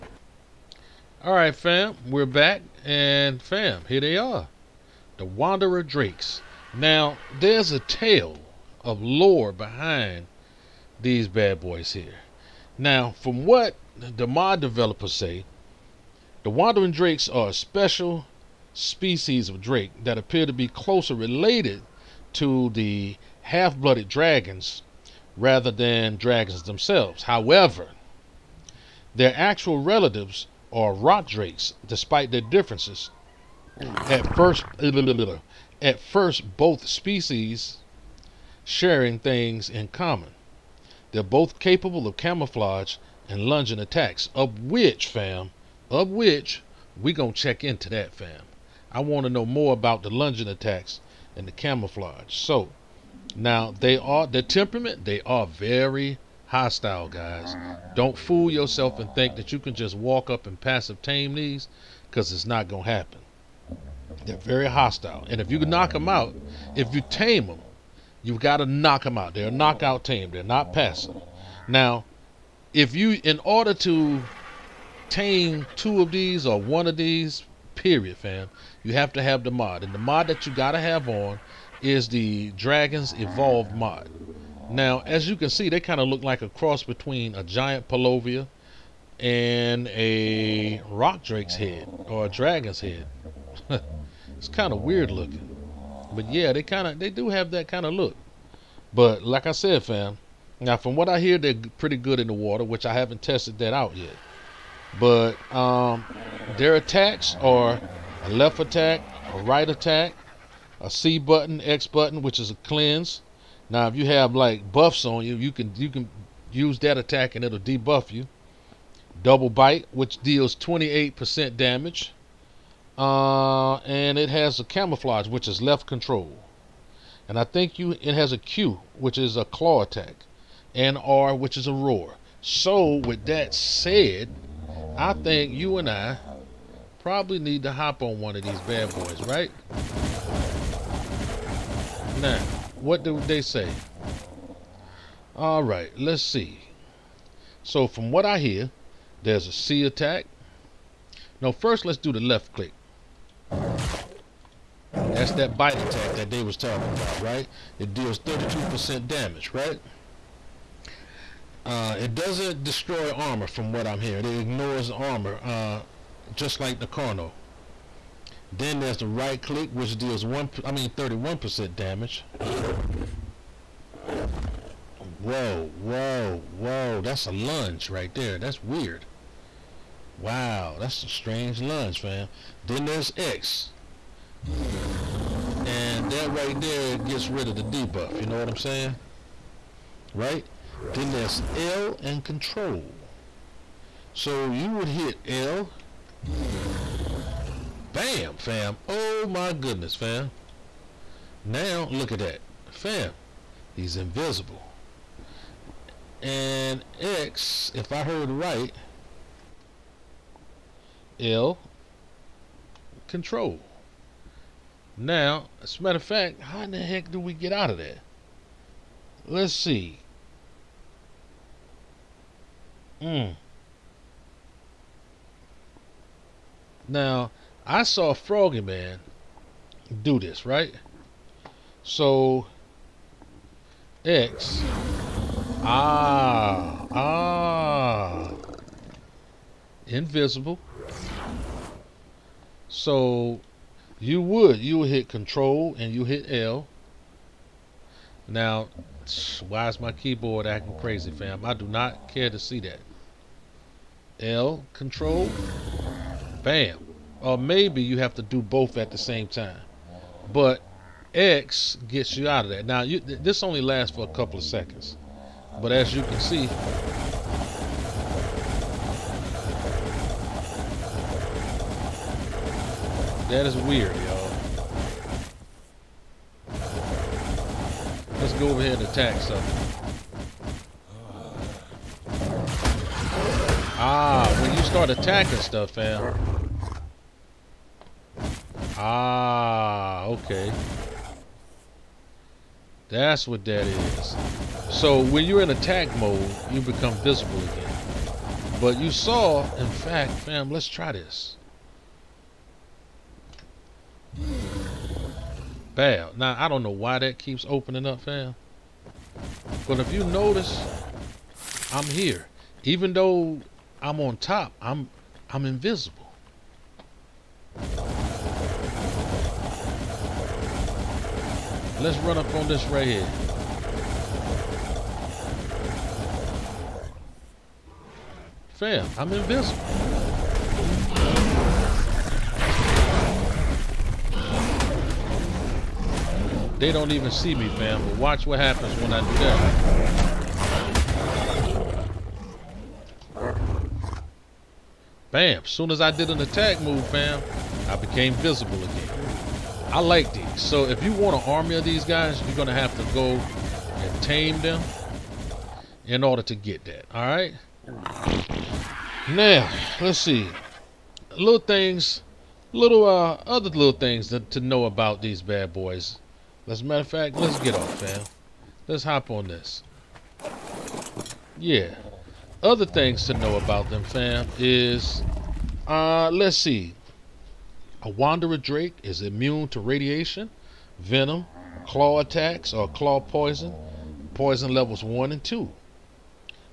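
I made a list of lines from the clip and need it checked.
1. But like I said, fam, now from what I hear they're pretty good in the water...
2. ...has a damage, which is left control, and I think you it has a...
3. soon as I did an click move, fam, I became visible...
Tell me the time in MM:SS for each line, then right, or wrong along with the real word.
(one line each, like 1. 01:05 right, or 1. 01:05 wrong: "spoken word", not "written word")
1. 01:38 right
2. 02:04 wrong: "camouflage", not "damage"
3. 05:45 wrong: "attack", not "click".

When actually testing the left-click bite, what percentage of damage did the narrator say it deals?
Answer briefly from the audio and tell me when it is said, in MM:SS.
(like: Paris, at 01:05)
32%, at 02:38.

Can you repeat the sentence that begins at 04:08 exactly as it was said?
Now, why is my keyboard acting crazy, fam?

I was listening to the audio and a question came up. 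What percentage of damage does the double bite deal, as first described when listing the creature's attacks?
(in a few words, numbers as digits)
28%.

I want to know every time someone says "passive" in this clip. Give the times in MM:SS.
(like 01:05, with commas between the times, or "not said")
01:00, 01:10.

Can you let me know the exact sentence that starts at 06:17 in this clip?
A wanderer drake is immune to radiation, venom, claw attacks, or claw poison, poison levels 1 and 2.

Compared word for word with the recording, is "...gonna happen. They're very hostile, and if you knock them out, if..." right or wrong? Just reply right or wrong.
right.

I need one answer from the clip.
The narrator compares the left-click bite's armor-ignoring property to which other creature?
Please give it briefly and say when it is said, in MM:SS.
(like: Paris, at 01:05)
Carno, at 02:46.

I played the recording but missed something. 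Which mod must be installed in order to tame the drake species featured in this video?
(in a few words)
Dragon's Evolved.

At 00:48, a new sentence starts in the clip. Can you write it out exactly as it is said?
I want to know more about the lunging attacks and the camouflage.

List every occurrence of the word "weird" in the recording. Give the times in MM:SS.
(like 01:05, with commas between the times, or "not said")
01:34, 02:58, 04:33.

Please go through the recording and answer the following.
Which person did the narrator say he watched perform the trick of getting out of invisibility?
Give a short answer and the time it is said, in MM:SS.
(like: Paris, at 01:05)
Froggy Man, at 03:48.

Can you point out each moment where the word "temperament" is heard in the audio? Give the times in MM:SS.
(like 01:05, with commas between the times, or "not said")
00:54.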